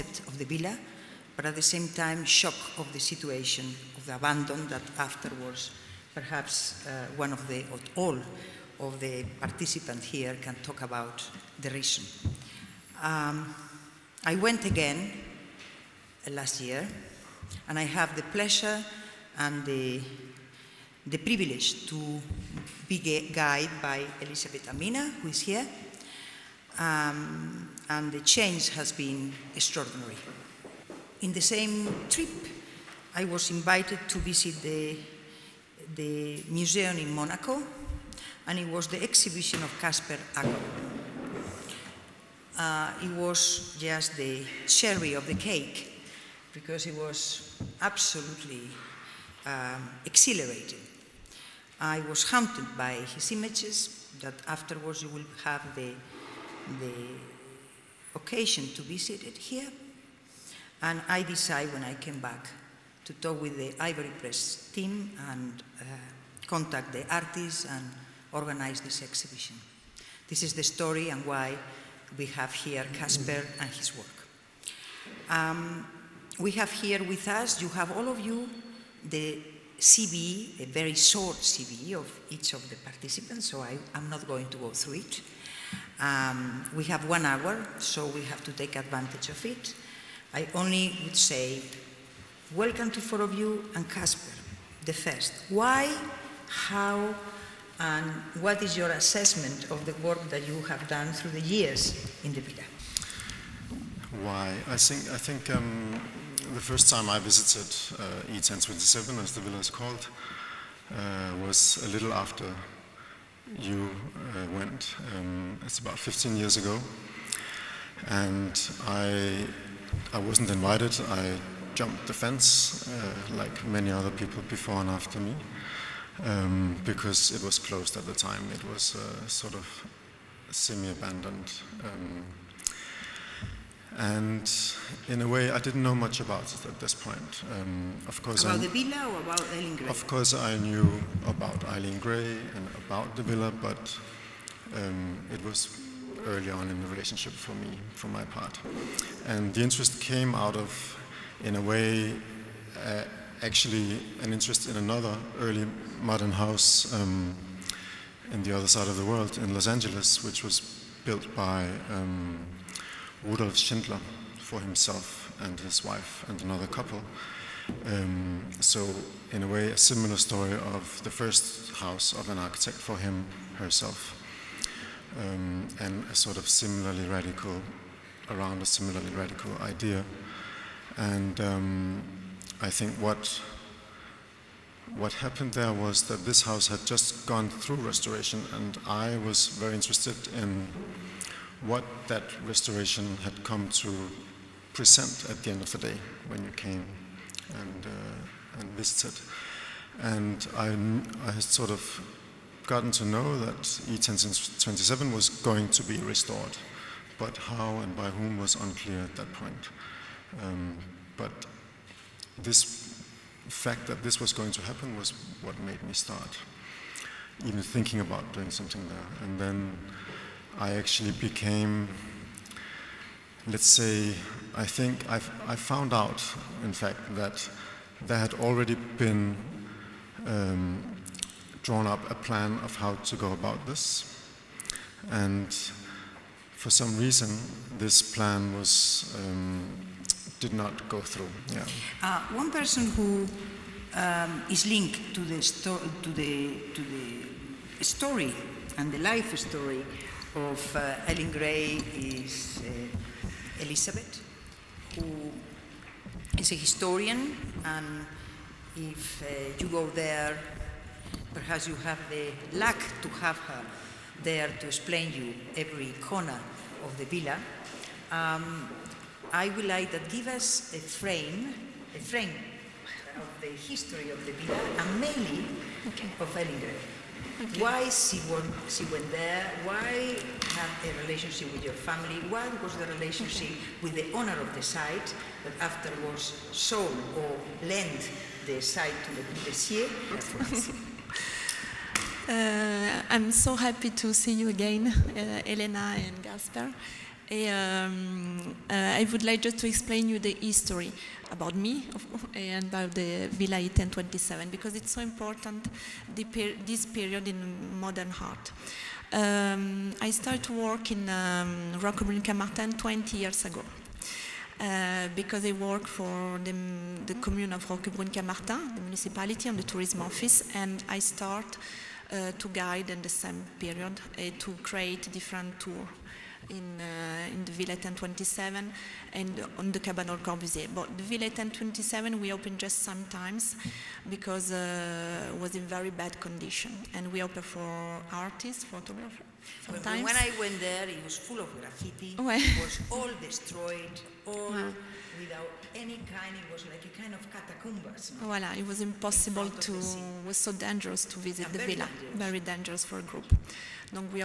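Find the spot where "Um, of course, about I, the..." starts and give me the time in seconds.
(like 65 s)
137 s.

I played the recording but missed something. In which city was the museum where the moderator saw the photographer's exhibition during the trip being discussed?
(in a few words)
Monaco.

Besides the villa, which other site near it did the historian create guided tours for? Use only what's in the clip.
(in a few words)
the Cabanon Corbusier.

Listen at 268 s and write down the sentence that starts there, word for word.
Um, I would like to give us a frame, a frame of the history of the villa and mainly okay.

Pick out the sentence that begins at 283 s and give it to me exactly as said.
with the owner of the site that afterwards sold or lent the site to the Corbusier.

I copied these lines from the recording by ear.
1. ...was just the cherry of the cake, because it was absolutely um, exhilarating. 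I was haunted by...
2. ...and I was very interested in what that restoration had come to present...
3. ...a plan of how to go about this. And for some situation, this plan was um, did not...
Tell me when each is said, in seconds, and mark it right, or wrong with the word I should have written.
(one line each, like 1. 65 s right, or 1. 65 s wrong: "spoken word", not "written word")
1. 43 s right
2. 188 s right
3. 232 s wrong: "reason", not "situation".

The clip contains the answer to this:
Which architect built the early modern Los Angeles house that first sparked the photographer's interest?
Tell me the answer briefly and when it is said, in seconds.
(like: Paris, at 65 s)
Rudolf Schindler, at 163 s.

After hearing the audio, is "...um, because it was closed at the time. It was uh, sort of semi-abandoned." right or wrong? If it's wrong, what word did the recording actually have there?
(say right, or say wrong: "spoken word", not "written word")
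right.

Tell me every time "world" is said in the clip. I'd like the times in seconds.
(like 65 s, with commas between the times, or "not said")
159 s.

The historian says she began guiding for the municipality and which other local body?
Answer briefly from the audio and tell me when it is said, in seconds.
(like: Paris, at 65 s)
the tourism office, at 319 s.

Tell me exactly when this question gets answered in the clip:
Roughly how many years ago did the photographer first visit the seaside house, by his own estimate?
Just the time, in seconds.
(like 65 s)
115 s.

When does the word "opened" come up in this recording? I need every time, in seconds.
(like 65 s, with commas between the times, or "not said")
332 s, 337 s.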